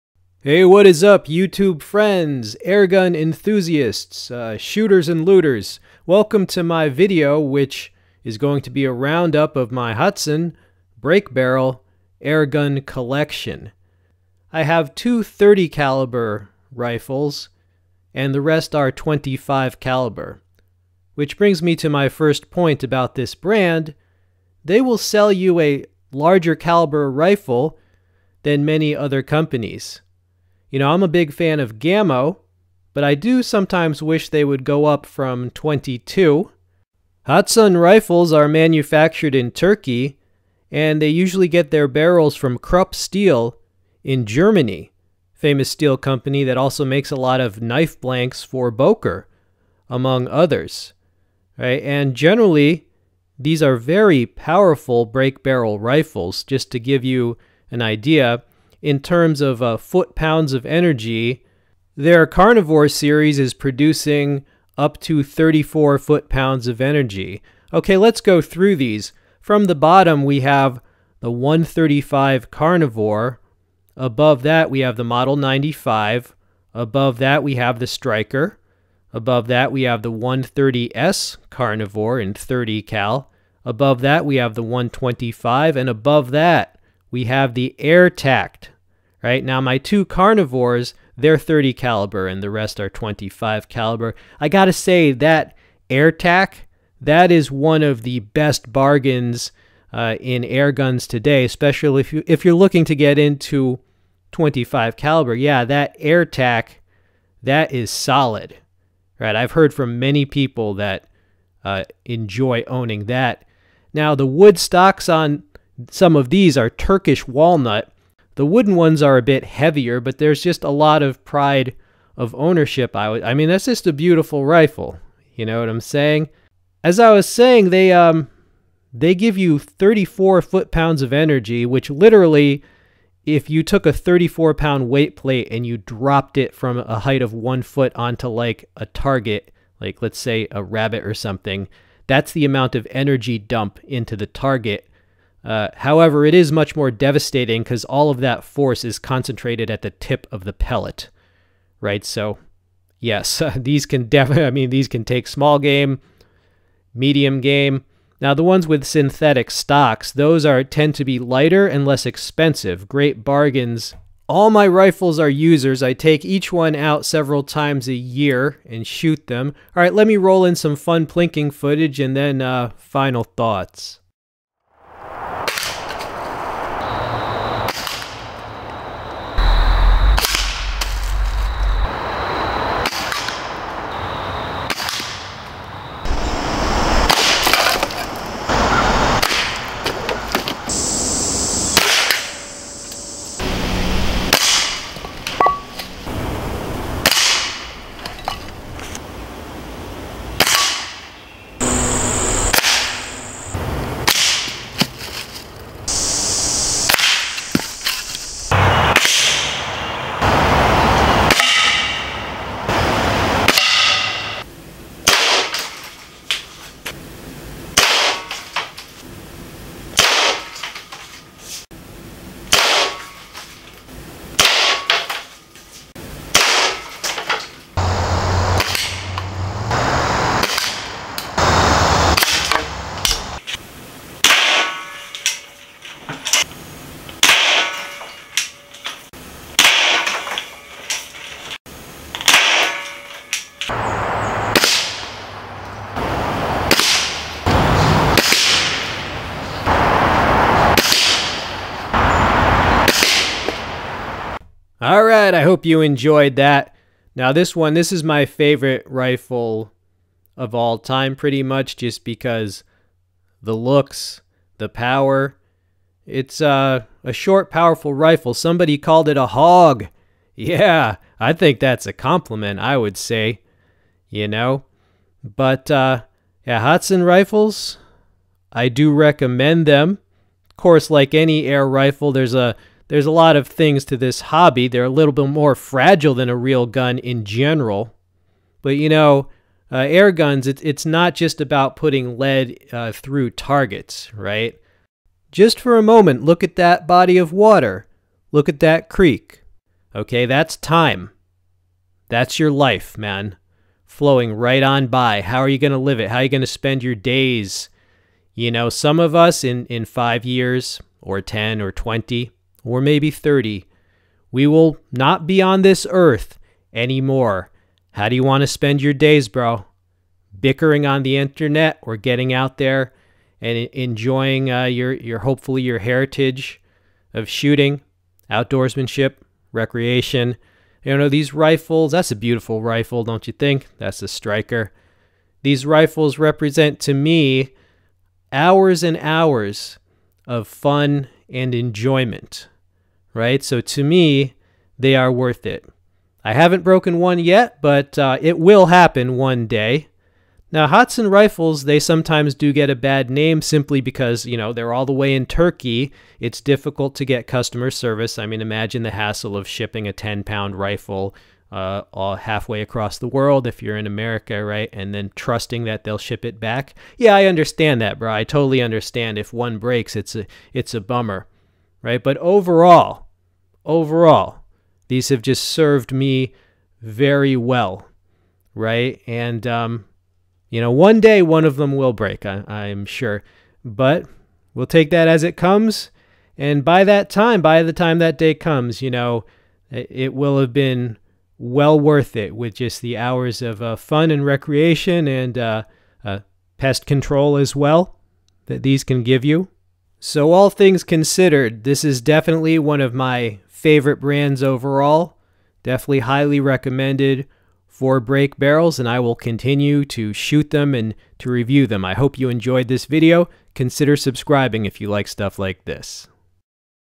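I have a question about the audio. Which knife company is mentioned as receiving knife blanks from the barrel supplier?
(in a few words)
Boker.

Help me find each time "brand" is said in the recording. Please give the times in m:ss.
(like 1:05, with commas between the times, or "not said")
0:23, 6:43.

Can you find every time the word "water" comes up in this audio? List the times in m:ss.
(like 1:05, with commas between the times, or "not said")
4:57.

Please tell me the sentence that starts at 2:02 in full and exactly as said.
I, mean, that's just a beautiful rifle.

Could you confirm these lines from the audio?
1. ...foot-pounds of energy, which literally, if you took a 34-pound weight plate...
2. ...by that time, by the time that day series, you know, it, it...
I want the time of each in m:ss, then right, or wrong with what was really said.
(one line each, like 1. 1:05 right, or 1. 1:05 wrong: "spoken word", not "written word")
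1. 2:10 right
2. 6:26 wrong: "comes", not "series".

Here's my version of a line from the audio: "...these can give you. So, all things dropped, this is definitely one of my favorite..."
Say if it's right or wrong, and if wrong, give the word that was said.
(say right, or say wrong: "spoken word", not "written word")
wrong: "considered", not "dropped".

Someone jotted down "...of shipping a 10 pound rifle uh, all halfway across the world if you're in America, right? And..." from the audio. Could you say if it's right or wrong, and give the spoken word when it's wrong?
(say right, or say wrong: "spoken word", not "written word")
right.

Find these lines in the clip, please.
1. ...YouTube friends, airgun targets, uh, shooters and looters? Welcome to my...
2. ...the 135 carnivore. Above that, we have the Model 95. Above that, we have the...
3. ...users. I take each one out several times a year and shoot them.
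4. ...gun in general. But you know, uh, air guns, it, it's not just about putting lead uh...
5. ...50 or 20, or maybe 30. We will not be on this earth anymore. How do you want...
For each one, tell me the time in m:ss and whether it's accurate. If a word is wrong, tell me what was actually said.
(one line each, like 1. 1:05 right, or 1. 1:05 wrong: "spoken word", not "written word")
1. 0:01 wrong: "enthusiasts", not "targets"
2. 1:11 right
3. 2:45 right
4. 4:46 right
5. 5:11 wrong: "10", not "50".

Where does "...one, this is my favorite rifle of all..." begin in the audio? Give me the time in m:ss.
4:17.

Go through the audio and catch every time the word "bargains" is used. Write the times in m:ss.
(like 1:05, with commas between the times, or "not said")
1:38, 2:43.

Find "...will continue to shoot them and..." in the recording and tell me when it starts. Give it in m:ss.
6:48.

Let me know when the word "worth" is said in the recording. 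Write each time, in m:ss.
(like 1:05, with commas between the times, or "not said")
5:45, 6:31.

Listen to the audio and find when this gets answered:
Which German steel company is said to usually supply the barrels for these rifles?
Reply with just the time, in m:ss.
0:42.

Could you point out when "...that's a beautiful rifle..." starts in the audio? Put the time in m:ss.
5:31.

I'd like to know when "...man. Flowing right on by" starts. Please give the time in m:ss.
5:02.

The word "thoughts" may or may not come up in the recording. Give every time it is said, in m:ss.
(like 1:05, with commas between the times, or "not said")
2:53.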